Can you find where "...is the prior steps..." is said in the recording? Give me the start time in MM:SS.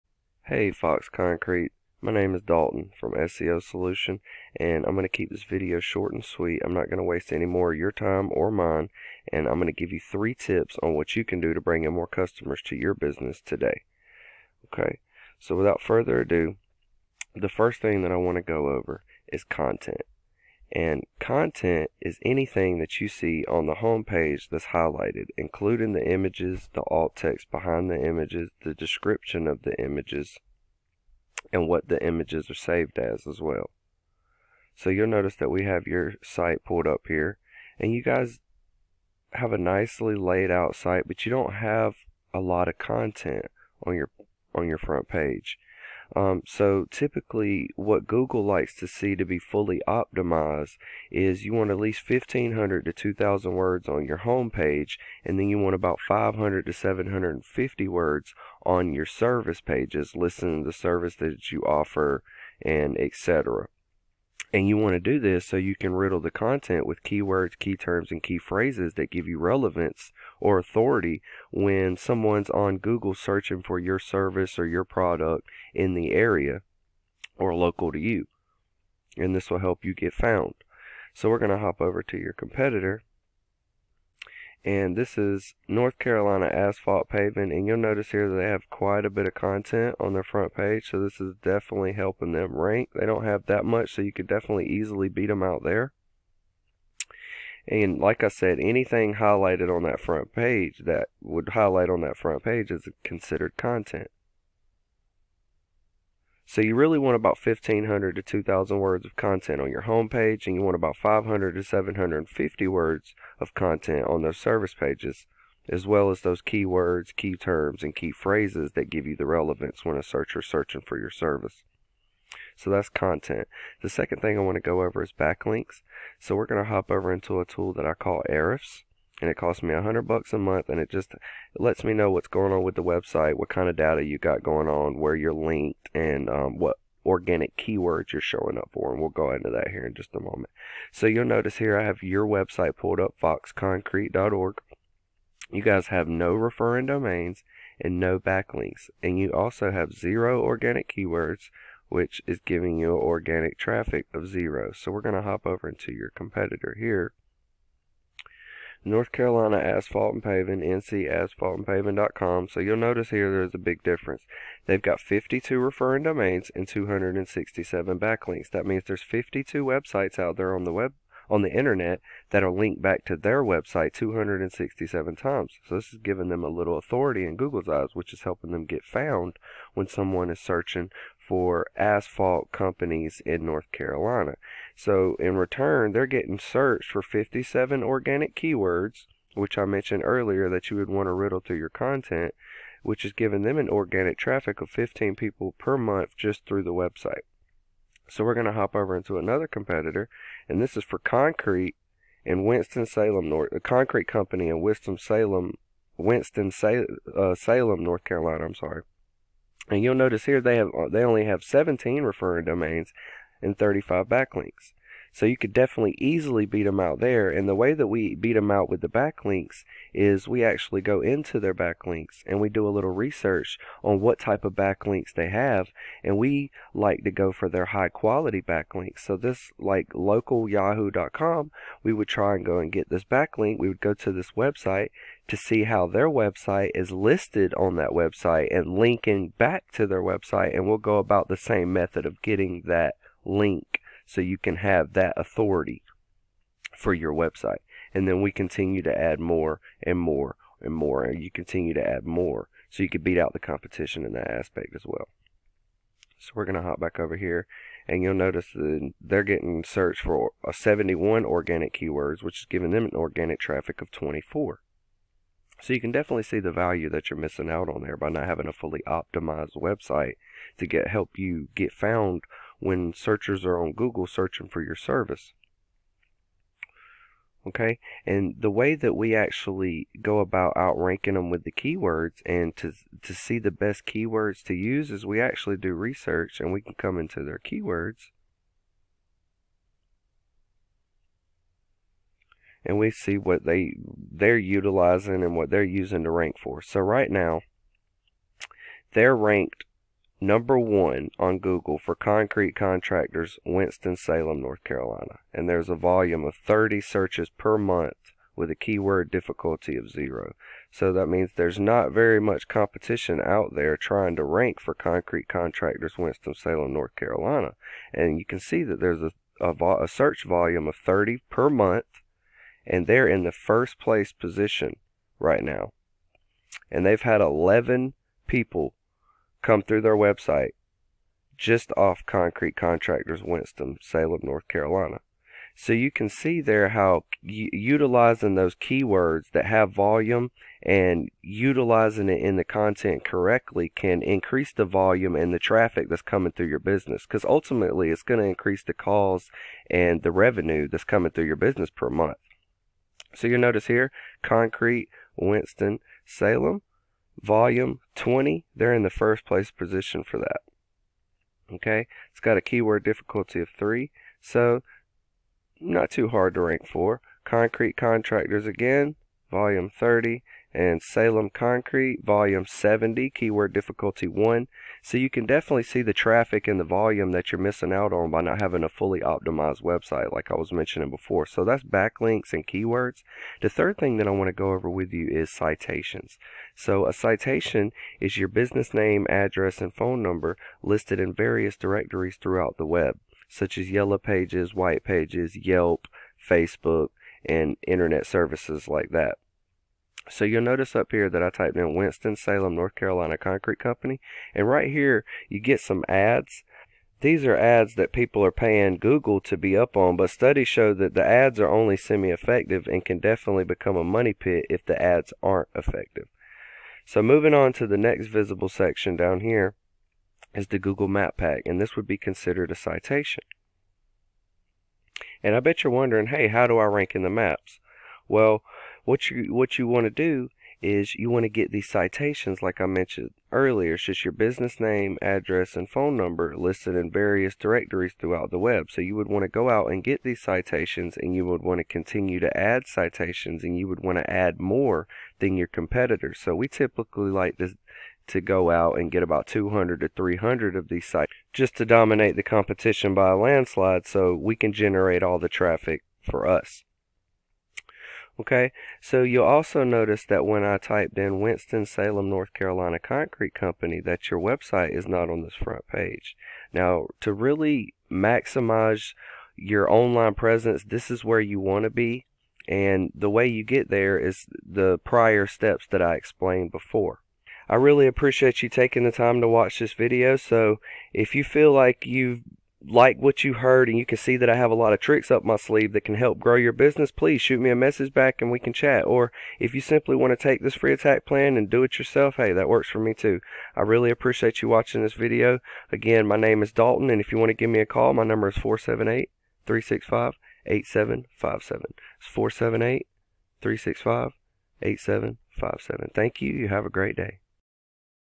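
07:53.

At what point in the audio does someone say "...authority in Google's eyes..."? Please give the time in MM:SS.
02:56.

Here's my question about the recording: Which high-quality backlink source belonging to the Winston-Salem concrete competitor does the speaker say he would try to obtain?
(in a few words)
local yahoo.com.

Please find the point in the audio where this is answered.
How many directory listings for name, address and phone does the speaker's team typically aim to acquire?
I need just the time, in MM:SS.
07:29.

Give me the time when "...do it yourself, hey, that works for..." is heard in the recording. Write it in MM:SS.
08:11.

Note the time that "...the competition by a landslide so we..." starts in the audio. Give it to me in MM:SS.
07:32.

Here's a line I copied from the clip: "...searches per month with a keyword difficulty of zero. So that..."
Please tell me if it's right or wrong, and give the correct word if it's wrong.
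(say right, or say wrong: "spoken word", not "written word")
right.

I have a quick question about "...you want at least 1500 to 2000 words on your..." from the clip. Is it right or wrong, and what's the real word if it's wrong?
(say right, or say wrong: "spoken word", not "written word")
right.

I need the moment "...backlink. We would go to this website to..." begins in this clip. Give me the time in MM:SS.
03:53.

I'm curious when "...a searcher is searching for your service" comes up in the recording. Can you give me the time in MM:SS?
01:59.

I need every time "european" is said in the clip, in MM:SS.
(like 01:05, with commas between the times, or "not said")
not said.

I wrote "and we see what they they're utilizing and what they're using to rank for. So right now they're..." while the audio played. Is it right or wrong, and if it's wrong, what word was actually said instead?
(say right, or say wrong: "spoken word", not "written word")
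right.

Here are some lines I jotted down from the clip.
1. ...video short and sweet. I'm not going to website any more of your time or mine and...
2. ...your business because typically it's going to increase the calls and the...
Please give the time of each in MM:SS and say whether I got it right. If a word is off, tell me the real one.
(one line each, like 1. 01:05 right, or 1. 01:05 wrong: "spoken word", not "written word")
1. 00:05 wrong: "waste", not "website"
2. 05:46 wrong: "ultimately", not "typically".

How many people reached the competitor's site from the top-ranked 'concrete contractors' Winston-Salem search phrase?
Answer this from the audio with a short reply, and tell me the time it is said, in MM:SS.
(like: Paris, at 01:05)
11, at 05:26.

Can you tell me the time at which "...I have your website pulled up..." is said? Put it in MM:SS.
02:21.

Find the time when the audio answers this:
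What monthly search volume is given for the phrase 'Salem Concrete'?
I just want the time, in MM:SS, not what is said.
06:10.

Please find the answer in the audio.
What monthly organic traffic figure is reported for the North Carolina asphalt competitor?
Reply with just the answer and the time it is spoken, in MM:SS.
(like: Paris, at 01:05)
15, at 03:13.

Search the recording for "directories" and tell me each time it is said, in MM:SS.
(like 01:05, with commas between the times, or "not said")
06:31, 07:17.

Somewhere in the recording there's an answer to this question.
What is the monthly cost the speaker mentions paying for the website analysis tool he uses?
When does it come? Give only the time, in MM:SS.
02:09.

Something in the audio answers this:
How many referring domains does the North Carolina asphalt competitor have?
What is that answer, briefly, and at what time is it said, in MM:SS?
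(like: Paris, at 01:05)
52, at 02:44.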